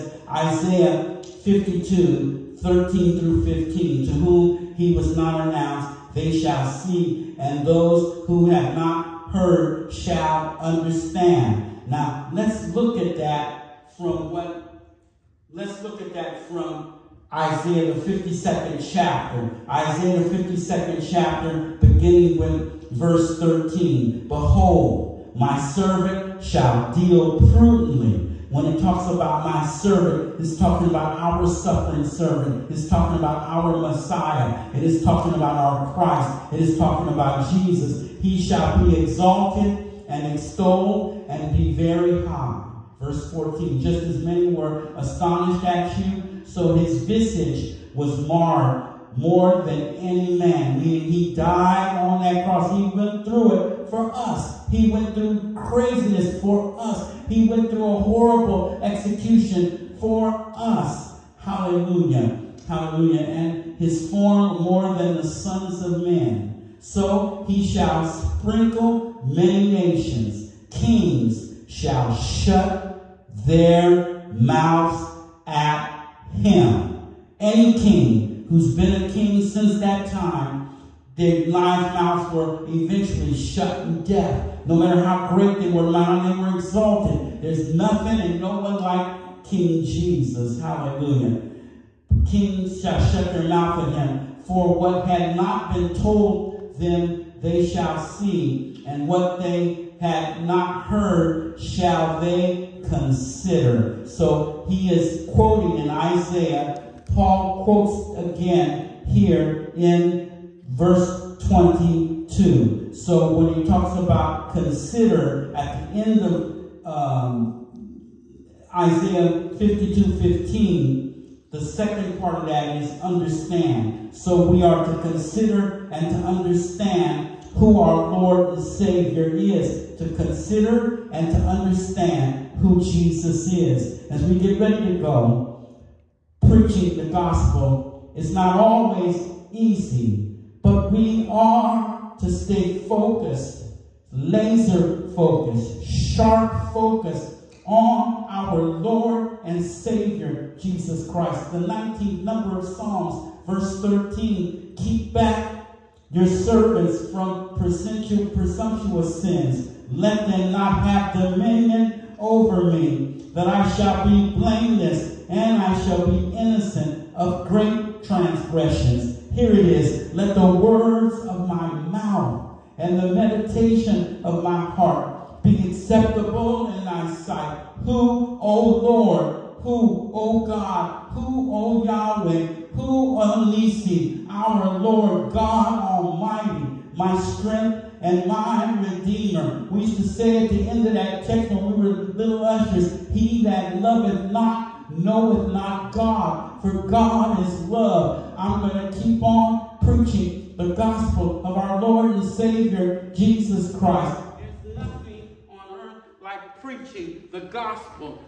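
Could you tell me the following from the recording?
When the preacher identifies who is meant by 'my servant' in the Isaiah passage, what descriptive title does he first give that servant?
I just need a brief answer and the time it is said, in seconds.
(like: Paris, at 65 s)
suffering servant, at 31 s.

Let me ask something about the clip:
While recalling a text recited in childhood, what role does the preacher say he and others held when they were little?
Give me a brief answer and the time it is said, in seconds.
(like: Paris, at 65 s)
ushers, at 192 s.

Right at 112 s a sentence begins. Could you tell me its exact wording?
So when he talks about consider at the end of um, Isaiah 52 15, the second part of that is understand.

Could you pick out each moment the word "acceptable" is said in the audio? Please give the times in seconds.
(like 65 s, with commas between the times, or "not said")
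175 s.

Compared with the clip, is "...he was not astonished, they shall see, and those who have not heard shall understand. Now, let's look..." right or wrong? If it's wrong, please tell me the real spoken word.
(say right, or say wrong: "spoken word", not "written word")
wrong: "announced", not "astonished".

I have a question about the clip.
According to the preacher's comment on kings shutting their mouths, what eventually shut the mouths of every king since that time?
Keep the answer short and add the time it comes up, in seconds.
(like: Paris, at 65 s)
death, at 84 s.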